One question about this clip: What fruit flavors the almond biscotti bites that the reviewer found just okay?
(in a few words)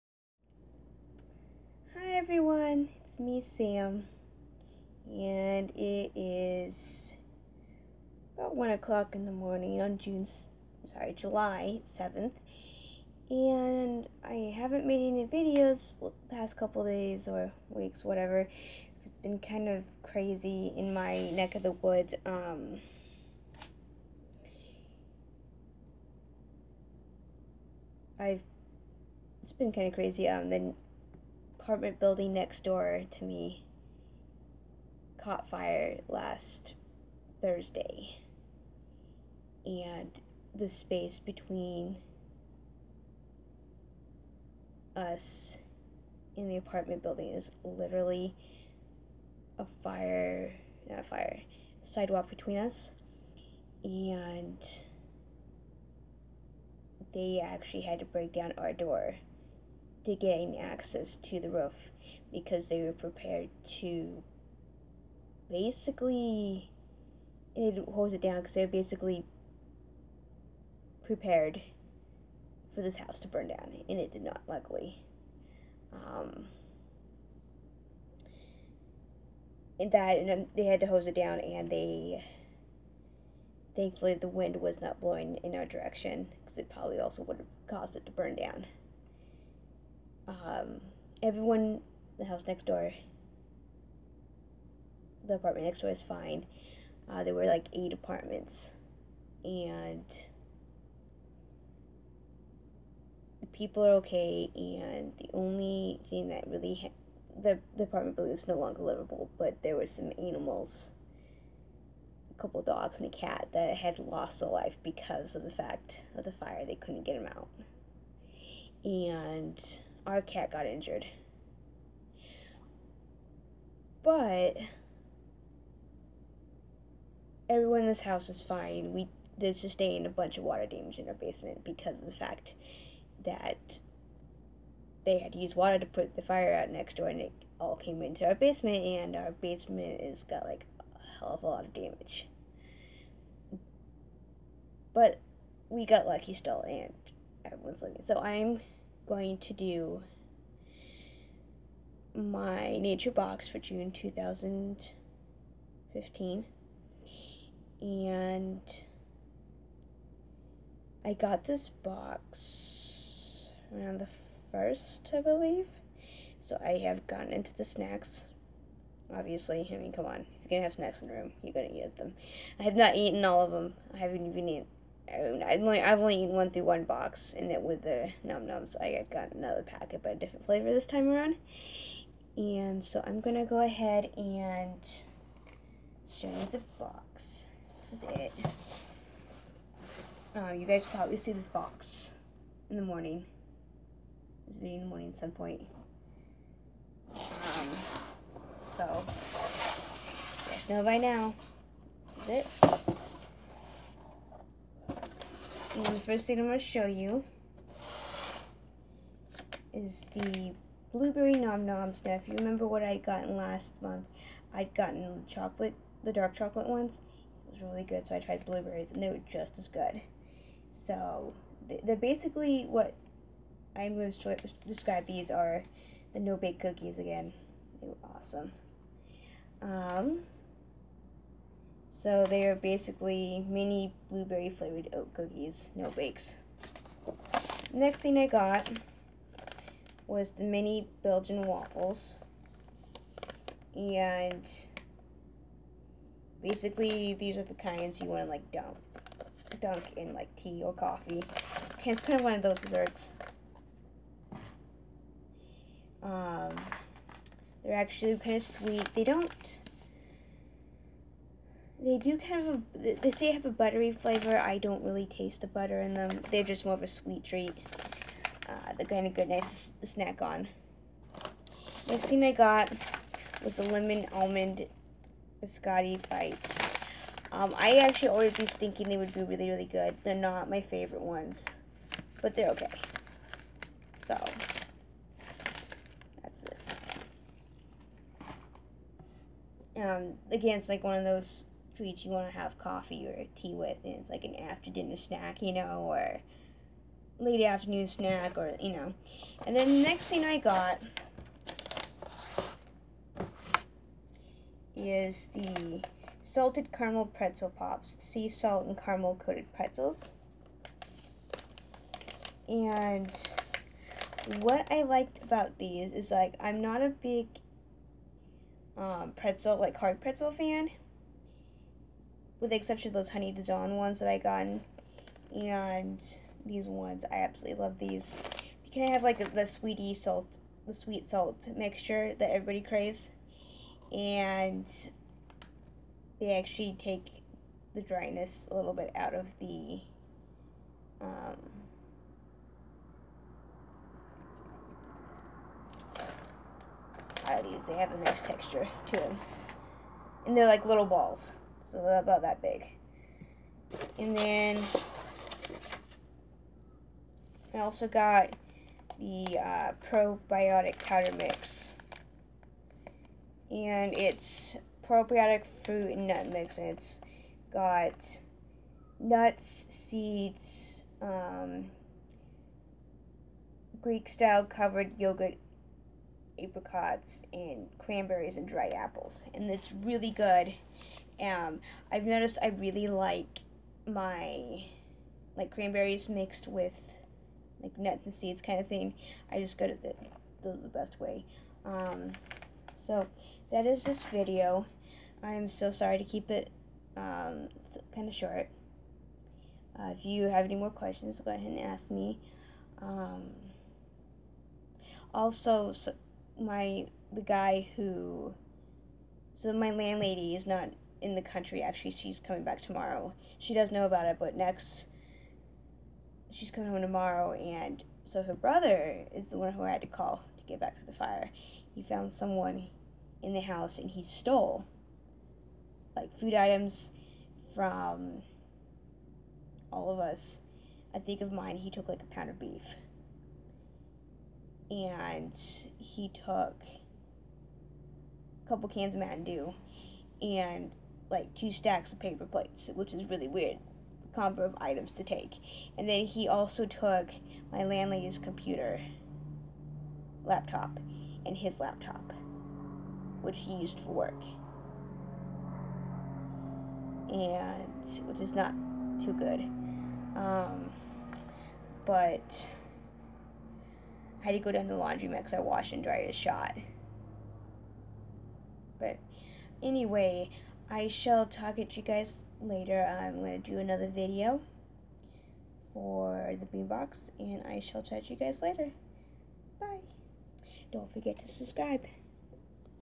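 Lemon.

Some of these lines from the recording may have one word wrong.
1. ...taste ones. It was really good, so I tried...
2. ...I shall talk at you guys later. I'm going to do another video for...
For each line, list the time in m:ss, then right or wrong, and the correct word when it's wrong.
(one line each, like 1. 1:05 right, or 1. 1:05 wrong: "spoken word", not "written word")
1. 3:36 wrong: "chocolate", not "taste"
2. 7:50 right.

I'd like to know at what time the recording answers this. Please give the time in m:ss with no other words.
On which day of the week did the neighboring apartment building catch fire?
0:36.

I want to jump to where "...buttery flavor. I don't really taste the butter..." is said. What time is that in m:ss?
4:23.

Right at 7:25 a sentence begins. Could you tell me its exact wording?
And then he also took my landlady's computer, laptop, and his laptop, which he used for work.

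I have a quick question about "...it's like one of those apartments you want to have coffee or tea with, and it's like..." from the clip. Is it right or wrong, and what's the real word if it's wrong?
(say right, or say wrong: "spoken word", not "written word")
wrong: "treats", not "apartments".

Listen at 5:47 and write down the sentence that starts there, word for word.
They have a nice texture to them, and they're like little balls.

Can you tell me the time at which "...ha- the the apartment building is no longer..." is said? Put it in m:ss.
1:46.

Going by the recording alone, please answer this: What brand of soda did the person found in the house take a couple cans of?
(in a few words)
Mountain Dew.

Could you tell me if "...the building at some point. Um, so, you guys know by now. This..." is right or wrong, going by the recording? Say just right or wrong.
wrong.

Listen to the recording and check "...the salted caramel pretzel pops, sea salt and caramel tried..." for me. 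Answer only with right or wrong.
wrong.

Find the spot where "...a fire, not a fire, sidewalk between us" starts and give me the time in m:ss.
0:49.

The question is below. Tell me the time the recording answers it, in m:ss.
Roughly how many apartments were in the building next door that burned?
1:37.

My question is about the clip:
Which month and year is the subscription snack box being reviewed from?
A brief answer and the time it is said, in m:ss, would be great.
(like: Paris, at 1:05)
June 2015, at 2:33.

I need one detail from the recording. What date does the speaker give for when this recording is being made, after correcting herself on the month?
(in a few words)
July 7th.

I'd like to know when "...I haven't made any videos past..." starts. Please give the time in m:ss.
0:14.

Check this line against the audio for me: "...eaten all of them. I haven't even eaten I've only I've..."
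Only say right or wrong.
right.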